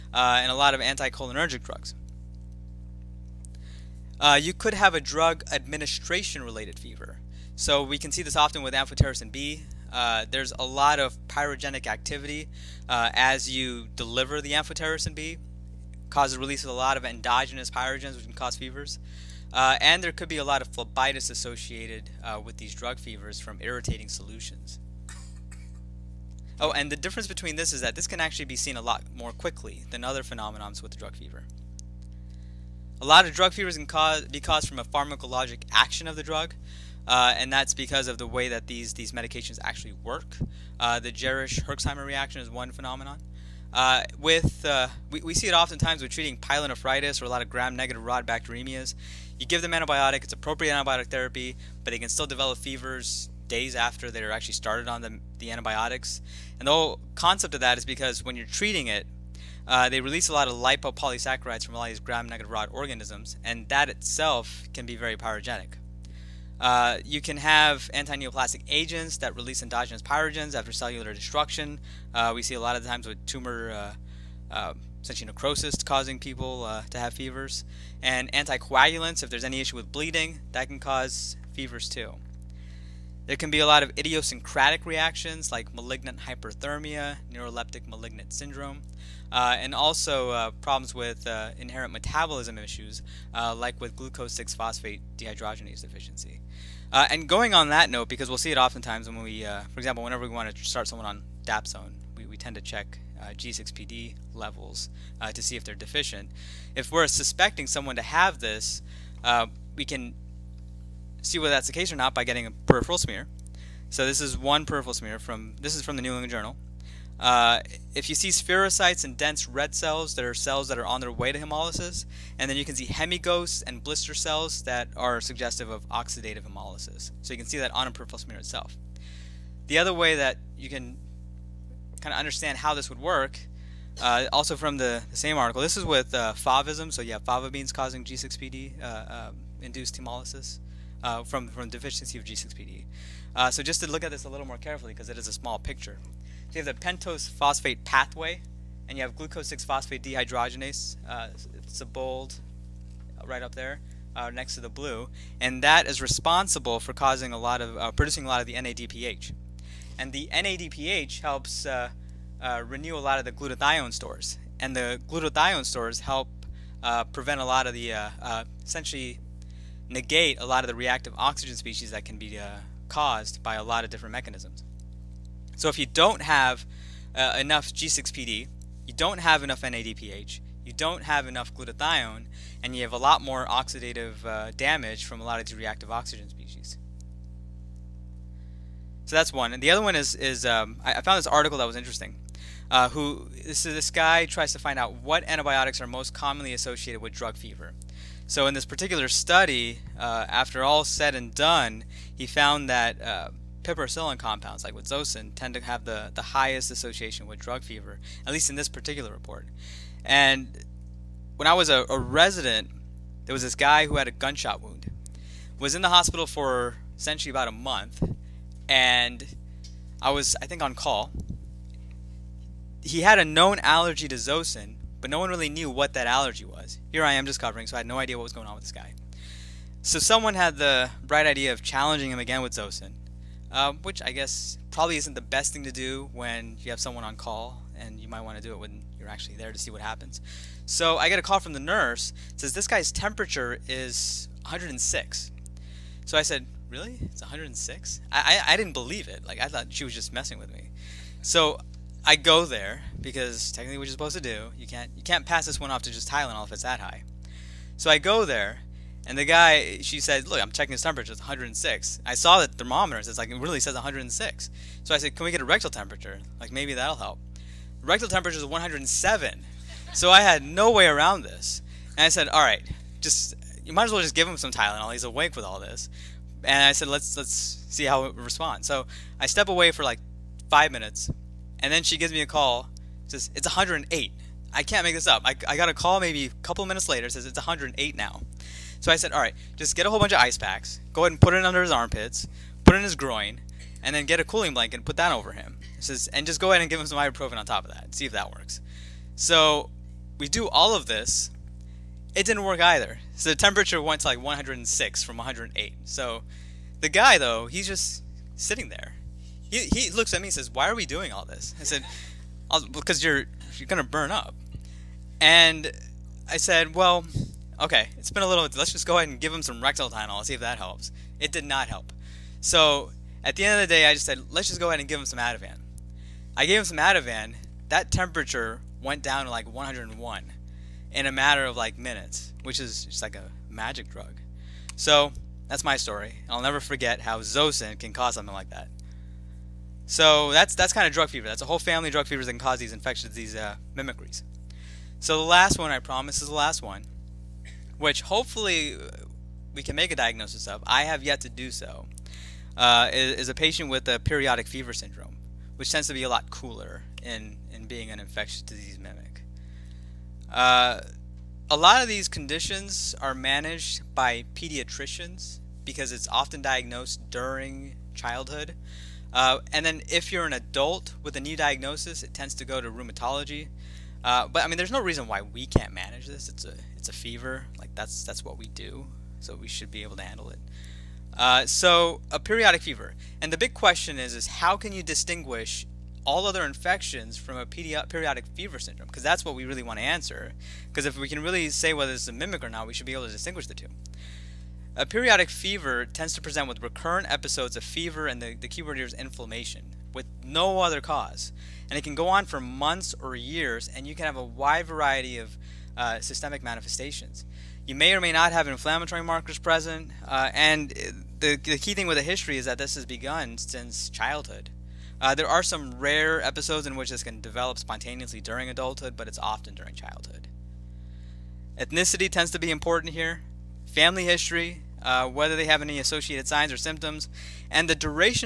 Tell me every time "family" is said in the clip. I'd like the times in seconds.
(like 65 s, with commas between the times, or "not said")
341 s, 423 s.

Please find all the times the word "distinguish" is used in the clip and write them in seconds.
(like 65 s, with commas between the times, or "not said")
384 s, 393 s.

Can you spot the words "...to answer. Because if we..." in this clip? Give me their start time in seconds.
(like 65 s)
389 s.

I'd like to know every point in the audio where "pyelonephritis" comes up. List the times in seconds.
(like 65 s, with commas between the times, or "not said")
46 s.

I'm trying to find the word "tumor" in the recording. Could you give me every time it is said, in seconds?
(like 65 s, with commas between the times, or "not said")
73 s.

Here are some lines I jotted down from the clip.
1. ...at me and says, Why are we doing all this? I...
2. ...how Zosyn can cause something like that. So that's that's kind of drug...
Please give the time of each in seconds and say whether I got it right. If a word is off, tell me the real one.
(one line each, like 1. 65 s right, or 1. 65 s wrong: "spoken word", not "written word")
1. 310 s right
2. 337 s right.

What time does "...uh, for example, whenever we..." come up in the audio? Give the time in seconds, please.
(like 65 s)
99 s.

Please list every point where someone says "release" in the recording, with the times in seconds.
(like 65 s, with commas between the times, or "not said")
16 s, 60 s, 69 s.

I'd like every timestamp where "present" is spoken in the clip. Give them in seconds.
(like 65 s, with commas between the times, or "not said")
396 s, 409 s.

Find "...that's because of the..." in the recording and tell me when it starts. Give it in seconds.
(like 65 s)
37 s.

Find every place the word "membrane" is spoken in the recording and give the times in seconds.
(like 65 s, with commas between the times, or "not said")
not said.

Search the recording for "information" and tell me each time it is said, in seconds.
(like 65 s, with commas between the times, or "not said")
not said.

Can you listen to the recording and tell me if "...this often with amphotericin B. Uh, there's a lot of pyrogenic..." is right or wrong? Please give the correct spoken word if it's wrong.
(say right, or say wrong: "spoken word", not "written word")
right.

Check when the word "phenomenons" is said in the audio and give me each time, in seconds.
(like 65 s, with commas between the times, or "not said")
30 s, 42 s.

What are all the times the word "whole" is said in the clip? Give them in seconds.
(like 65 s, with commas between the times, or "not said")
56 s, 289 s, 341 s.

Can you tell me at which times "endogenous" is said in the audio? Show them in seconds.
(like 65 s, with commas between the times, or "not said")
17 s, 69 s.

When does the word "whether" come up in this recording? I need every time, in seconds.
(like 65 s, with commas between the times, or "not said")
111 s, 391 s, 425 s.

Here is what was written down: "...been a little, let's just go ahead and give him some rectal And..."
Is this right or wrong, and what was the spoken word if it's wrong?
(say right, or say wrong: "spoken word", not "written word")
wrong: "Tylenol", not "And".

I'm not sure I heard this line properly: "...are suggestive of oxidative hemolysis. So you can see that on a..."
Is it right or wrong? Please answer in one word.
right.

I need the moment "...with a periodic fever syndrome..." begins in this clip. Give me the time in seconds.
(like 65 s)
353 s.